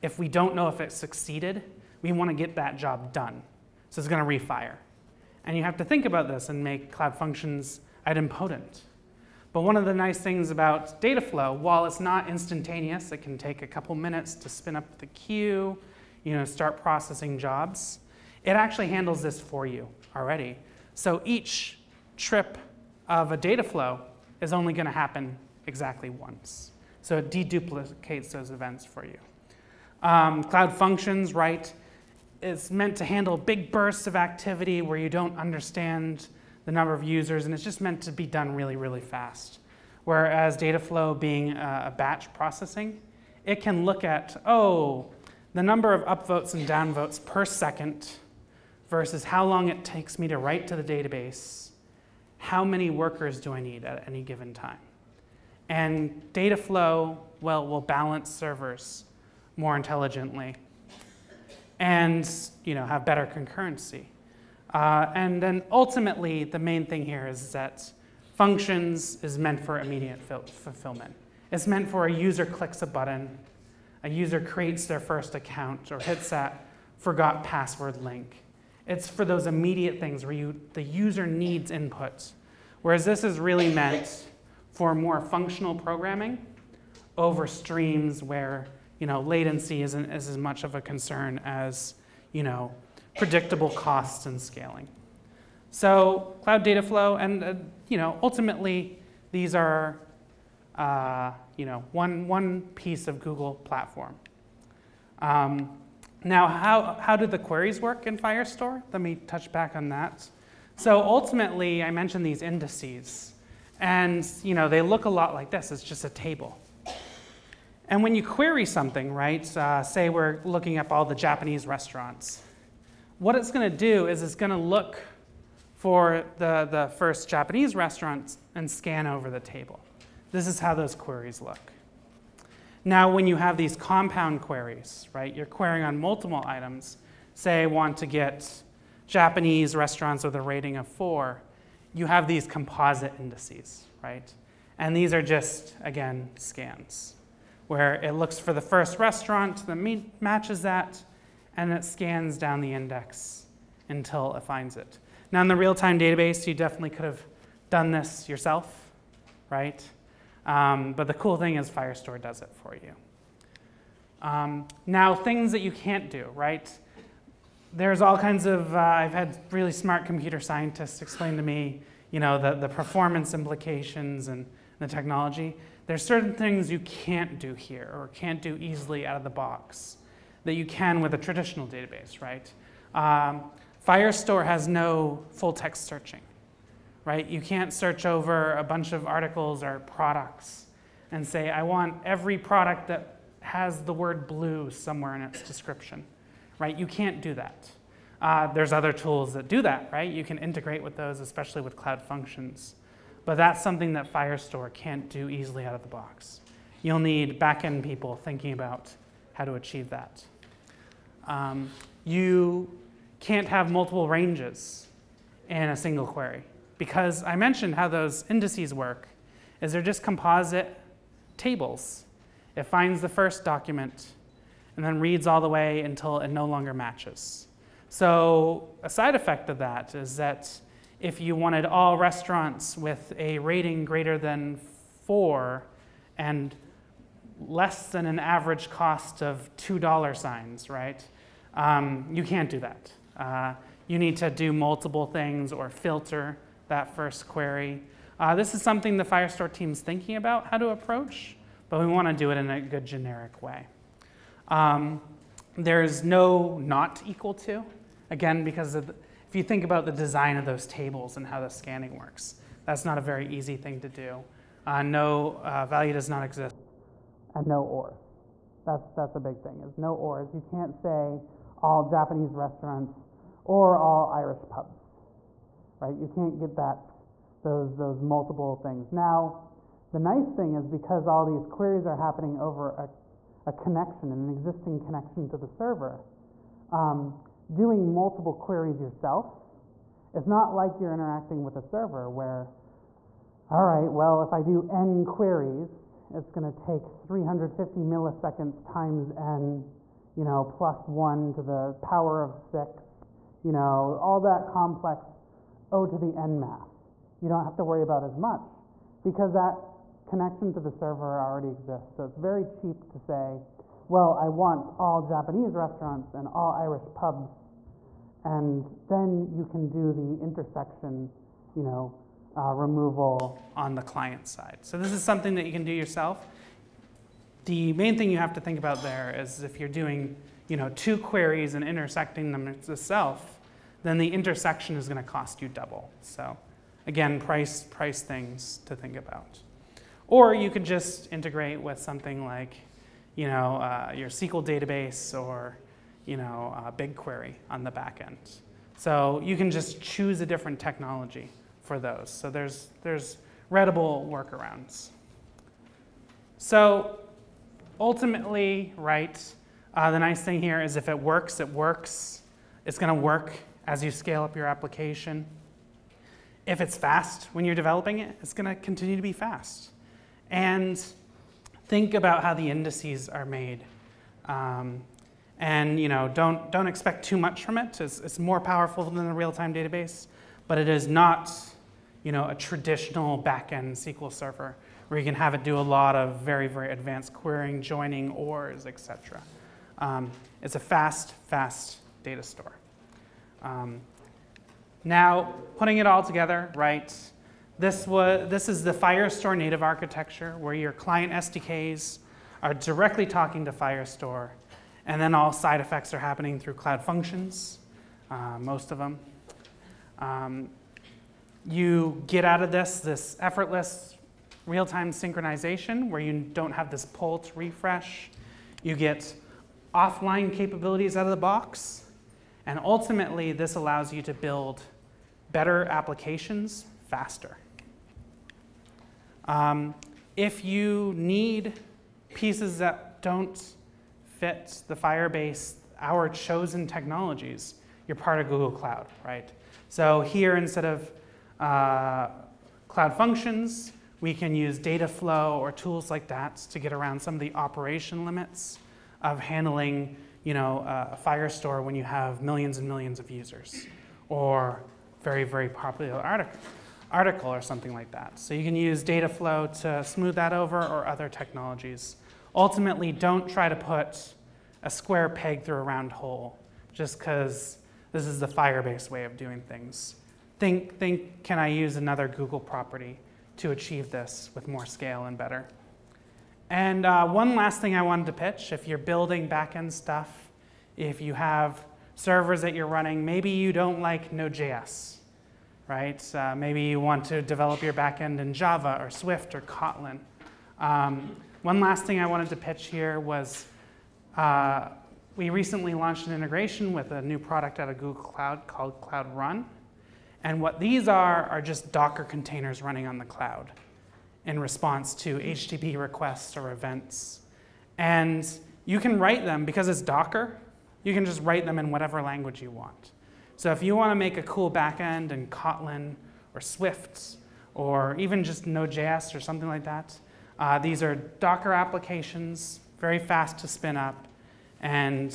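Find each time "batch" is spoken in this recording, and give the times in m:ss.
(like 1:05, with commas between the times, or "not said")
0:41.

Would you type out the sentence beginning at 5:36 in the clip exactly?
So again, price, price things to think about.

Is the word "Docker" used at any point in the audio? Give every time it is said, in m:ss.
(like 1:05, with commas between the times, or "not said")
8:21, 8:29, 8:40.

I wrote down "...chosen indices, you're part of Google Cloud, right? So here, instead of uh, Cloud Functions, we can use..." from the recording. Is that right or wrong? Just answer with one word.
wrong.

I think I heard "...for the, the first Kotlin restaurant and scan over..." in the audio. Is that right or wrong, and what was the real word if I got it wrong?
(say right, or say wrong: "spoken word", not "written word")
wrong: "Japanese", not "Kotlin".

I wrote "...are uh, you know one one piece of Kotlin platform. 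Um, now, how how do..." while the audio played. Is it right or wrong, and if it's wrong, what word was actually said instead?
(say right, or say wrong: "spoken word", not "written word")
wrong: "Google", not "Kotlin".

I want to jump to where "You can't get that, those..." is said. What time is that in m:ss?
4:35.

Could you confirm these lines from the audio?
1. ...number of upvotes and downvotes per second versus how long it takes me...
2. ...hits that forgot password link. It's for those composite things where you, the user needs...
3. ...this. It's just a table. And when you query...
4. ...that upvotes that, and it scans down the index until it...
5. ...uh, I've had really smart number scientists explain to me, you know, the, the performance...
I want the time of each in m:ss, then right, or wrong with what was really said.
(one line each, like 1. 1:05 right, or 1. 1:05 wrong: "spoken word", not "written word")
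1. 0:45 right
2. 1:15 wrong: "immediate", not "composite"
3. 1:55 right
4. 2:29 wrong: "matches", not "upvotes"
5. 2:48 wrong: "computer", not "number".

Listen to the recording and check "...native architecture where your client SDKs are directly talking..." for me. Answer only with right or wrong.
right.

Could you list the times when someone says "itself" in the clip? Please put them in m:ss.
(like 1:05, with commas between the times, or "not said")
5:32.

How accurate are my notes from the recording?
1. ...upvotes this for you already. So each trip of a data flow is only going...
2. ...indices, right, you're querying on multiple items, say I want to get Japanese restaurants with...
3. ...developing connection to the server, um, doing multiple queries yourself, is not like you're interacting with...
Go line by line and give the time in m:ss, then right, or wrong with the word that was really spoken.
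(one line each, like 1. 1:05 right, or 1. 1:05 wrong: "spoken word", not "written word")
1. 0:18 wrong: "handles", not "upvotes"
2. 2:14 wrong: "queries", not "indices"
3. 4:44 wrong: "existing", not "developing".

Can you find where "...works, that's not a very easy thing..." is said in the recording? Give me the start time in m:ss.
4:21.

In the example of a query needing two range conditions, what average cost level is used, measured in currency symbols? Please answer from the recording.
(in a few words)
$2 signs.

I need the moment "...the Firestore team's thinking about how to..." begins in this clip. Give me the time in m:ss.
4:08.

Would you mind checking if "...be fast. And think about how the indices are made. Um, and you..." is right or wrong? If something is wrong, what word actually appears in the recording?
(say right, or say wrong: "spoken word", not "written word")
right.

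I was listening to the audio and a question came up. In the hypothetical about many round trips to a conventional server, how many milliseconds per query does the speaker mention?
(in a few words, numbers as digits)
350.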